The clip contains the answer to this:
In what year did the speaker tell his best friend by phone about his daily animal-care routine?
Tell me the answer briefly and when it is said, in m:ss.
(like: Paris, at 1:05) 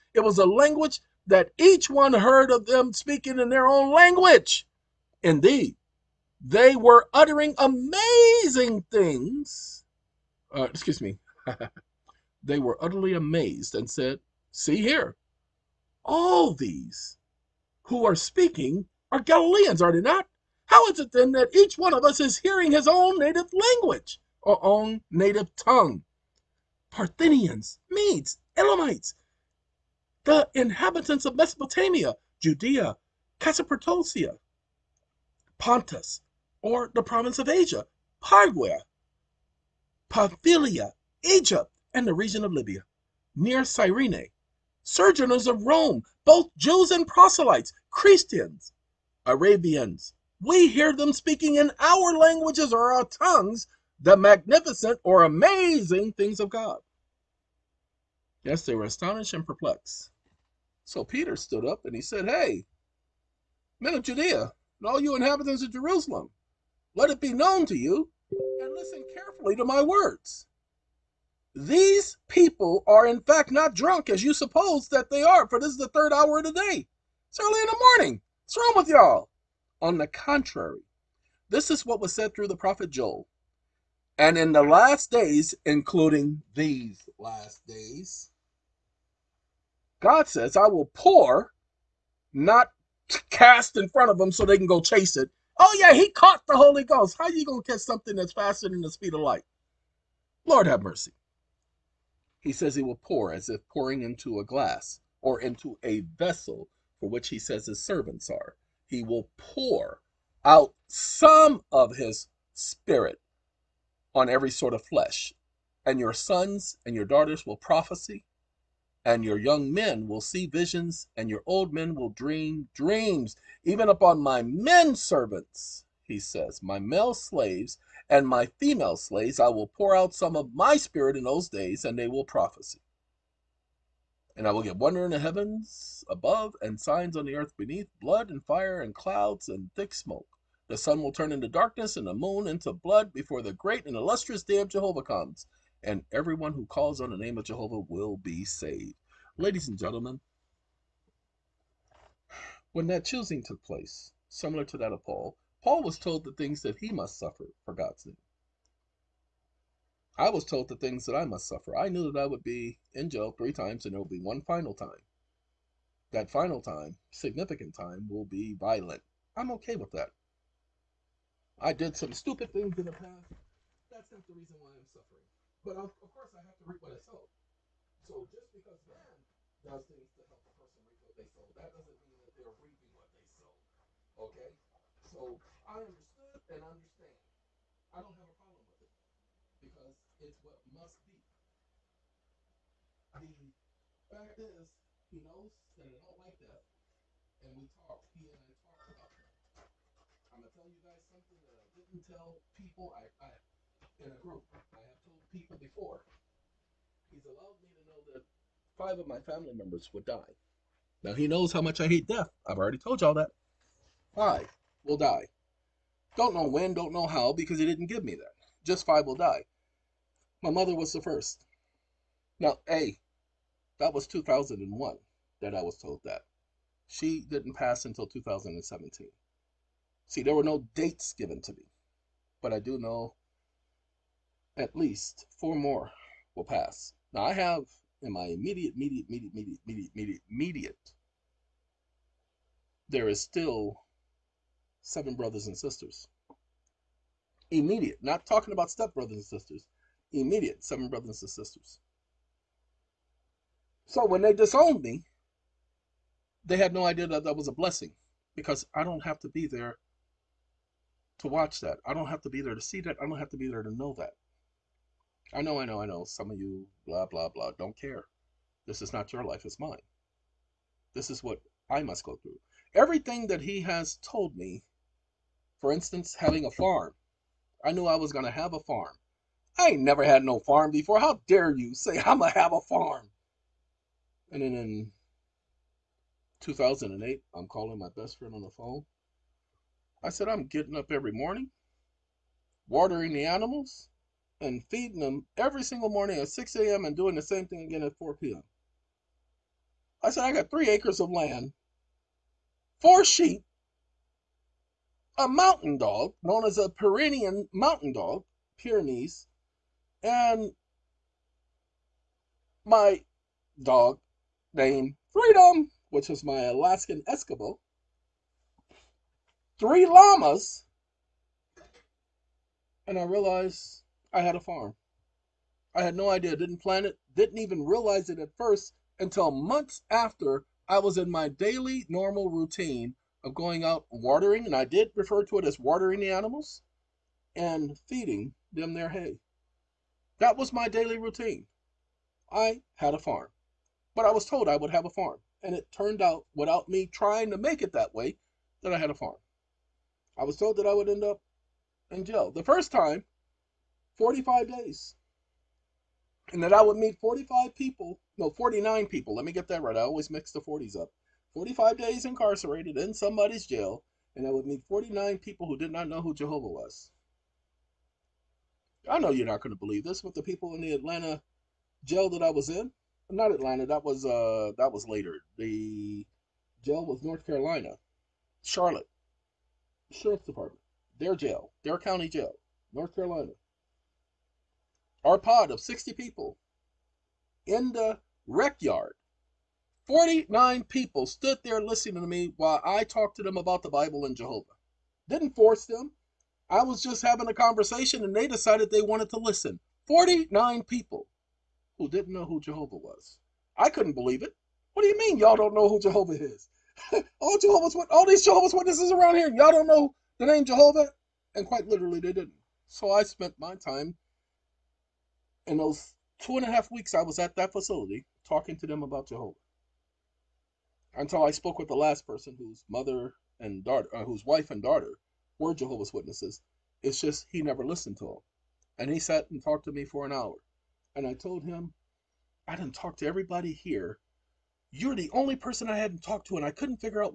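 2008, at 4:46.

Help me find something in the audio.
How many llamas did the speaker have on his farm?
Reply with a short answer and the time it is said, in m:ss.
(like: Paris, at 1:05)
3, at 5:19.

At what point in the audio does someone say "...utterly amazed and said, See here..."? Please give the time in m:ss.
0:12.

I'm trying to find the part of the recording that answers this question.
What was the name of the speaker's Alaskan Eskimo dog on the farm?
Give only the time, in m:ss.
5:15.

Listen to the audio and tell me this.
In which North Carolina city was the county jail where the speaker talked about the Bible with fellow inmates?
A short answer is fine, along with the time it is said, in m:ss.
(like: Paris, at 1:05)
Charlotte, at 6:18.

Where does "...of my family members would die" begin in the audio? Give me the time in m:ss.
3:28.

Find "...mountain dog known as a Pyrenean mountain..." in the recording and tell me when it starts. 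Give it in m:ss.
5:05.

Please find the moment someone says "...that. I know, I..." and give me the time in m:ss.
4:23.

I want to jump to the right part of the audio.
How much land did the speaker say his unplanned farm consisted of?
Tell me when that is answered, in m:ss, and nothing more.
5:00.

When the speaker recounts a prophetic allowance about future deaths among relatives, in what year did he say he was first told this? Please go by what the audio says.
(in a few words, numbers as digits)
2001.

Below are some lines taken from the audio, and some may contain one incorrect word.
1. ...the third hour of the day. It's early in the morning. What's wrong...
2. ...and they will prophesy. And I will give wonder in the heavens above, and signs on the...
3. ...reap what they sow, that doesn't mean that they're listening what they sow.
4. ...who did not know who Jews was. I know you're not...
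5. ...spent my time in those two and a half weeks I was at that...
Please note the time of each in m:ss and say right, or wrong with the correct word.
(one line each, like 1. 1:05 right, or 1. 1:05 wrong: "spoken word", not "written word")
1. 1:15 right
2. 2:11 right
3. 3:00 wrong: "reaping", not "listening"
4. 6:05 wrong: "Jehovah", not "Jews"
5. 6:53 right.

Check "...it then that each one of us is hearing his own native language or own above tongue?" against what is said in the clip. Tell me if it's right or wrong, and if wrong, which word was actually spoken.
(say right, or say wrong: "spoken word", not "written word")
wrong: "native", not "above".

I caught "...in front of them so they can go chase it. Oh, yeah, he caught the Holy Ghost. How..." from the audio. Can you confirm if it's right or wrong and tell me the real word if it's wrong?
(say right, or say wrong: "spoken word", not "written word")
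right.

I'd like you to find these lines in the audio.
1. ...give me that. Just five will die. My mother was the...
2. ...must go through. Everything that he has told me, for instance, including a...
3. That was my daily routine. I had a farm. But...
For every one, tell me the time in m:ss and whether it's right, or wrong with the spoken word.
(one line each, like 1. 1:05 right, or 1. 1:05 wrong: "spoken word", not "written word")
1. 3:37 right
2. 4:31 wrong: "having", not "including"
3. 5:40 right.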